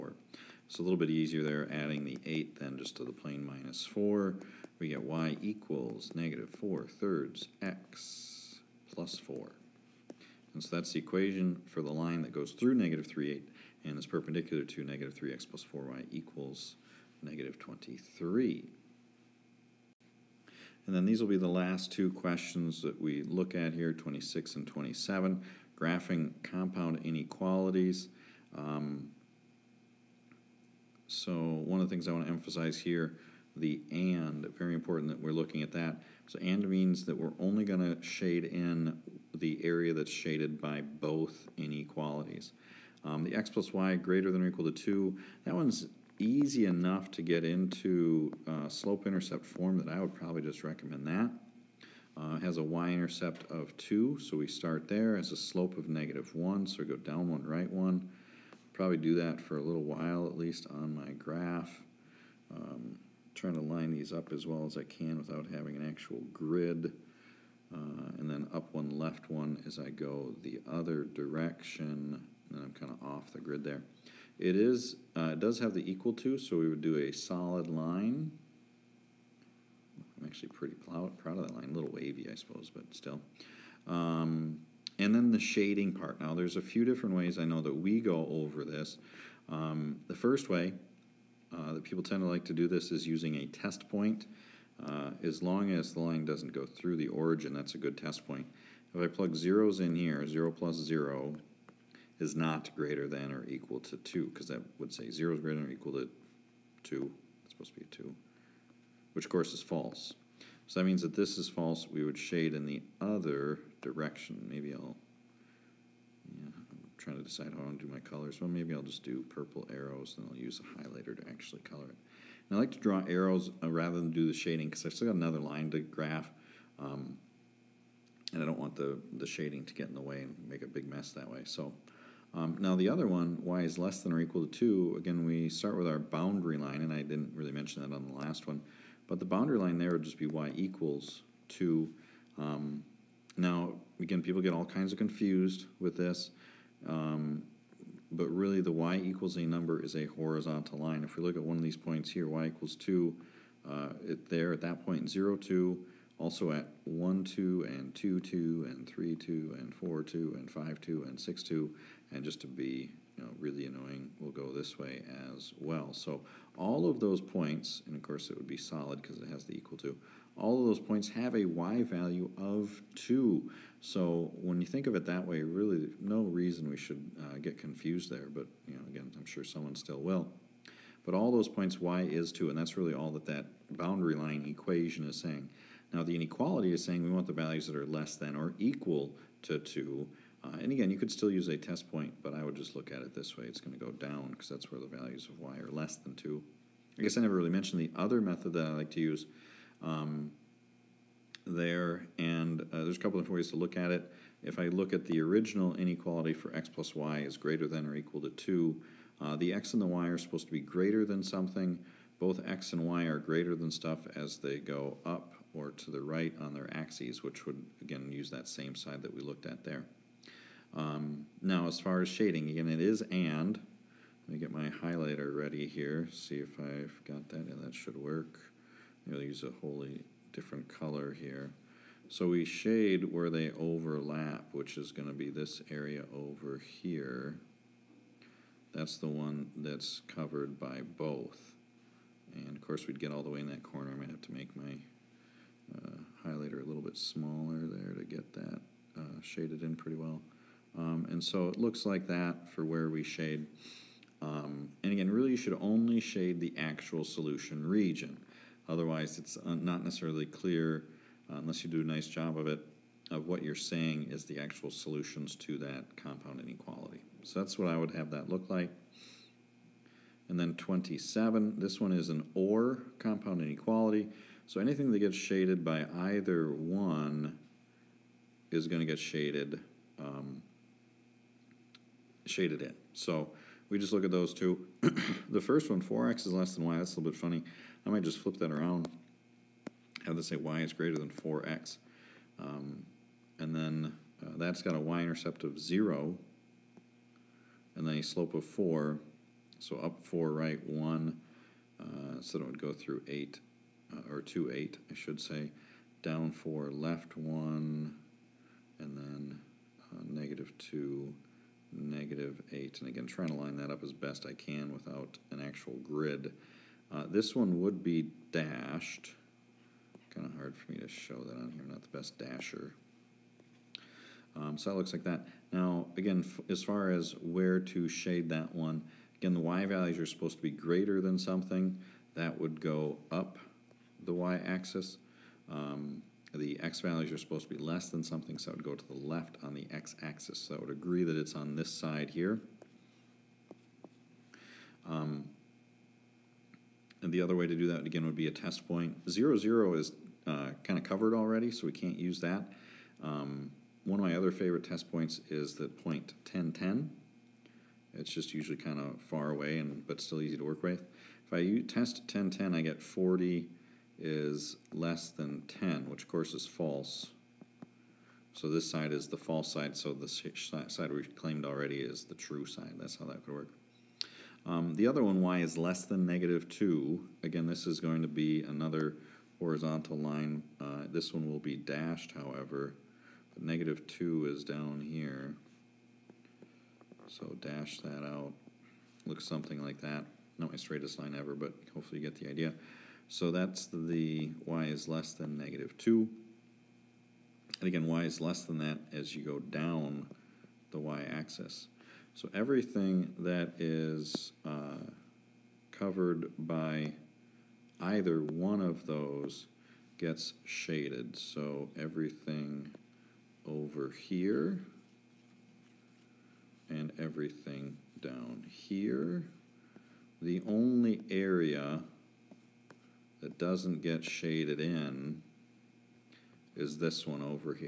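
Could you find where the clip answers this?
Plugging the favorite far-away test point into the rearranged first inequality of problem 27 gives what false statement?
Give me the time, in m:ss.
6:02.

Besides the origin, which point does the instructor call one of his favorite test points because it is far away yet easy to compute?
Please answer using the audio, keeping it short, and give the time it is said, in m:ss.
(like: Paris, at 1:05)
10, 10, at 5:55.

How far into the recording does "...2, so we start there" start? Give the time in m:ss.
0:53.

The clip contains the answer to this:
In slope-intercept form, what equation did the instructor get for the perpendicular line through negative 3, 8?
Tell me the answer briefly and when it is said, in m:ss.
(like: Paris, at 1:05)
y = -4/3x + 4, at 0:05.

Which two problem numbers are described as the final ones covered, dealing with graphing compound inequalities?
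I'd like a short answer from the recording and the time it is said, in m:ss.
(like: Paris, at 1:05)
26 and 27, at 0:23.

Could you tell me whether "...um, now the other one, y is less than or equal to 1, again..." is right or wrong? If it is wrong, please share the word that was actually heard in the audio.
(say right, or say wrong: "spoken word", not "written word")
wrong: "2", not "1".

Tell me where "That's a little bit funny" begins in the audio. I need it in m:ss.
4:46.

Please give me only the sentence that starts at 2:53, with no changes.
So when you think of it that way, really no reason we should uh, get confused there.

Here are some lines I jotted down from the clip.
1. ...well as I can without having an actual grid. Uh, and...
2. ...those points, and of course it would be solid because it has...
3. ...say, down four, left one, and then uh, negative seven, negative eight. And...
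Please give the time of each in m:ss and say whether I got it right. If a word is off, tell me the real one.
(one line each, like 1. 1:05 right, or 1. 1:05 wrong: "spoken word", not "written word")
1. 1:04 right
2. 2:46 right
3. 5:05 wrong: "two", not "seven".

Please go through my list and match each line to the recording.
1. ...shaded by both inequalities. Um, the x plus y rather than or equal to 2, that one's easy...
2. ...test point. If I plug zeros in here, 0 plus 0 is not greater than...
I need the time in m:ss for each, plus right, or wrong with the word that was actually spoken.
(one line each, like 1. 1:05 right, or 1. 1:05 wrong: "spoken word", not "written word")
1. 0:40 wrong: "greater", not "rather"
2. 1:37 right.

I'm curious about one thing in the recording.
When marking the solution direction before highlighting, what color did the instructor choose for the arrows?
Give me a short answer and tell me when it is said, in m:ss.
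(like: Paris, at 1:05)
Purple, at 1:59.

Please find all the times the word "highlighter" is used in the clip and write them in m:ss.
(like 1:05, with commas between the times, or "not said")
2:00, 3:44, 4:06.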